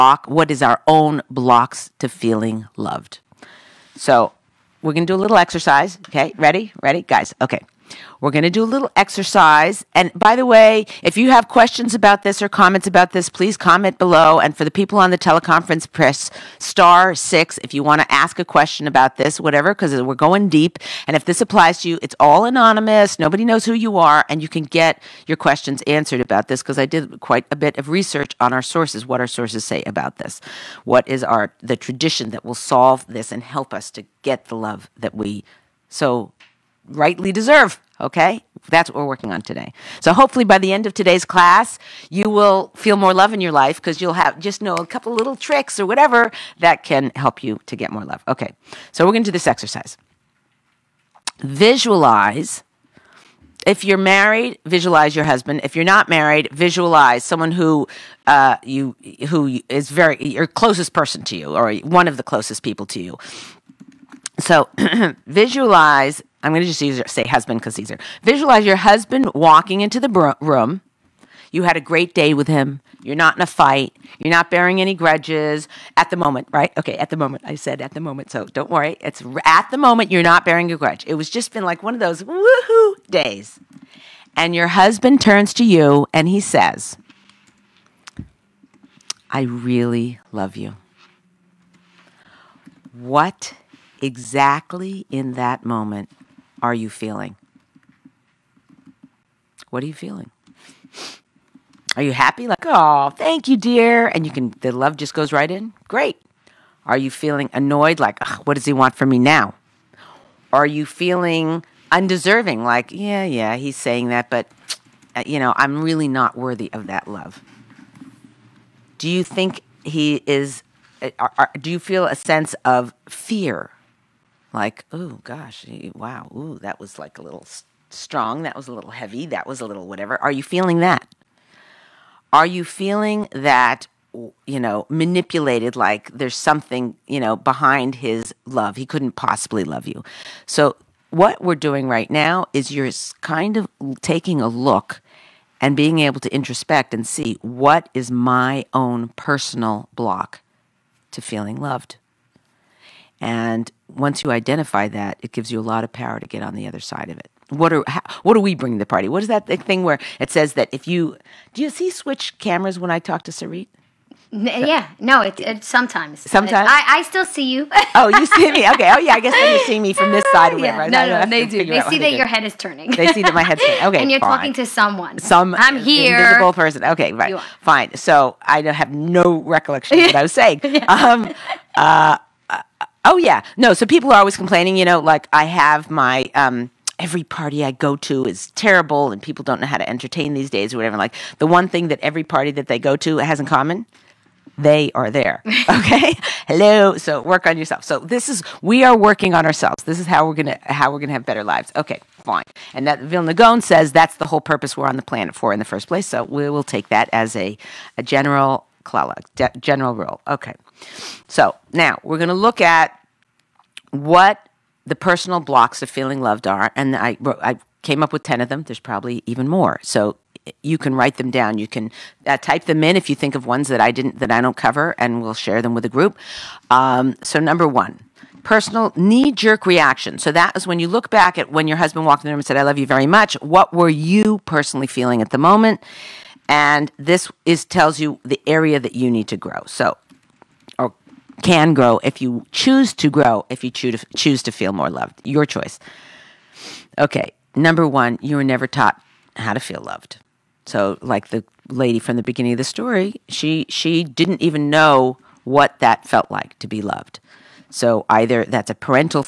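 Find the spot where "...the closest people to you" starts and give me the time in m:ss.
1:02.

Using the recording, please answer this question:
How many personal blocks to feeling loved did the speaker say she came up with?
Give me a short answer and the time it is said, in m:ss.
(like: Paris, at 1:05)
10, at 3:38.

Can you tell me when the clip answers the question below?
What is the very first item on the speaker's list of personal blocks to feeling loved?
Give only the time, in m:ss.
4:08.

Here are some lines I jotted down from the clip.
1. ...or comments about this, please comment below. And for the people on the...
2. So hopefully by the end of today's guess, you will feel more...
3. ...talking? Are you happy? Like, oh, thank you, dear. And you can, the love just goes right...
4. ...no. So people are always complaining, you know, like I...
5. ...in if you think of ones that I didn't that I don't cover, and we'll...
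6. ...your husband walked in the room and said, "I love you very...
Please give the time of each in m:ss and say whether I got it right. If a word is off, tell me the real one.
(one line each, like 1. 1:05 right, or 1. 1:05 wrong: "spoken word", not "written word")
1. 0:12 right
2. 0:40 wrong: "class", not "guess"
3. 1:39 wrong: "feeling", not "talking"
4. 3:03 right
5. 3:42 right
6. 3:51 right.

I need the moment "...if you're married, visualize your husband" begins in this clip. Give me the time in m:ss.
0:53.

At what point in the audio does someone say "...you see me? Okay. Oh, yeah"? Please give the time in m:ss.
2:48.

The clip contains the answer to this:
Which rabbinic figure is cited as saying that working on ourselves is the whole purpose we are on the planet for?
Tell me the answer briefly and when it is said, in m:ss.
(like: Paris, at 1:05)
Vilna Gaon, at 3:23.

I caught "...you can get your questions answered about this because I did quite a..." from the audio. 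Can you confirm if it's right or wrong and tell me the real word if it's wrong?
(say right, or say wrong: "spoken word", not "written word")
right.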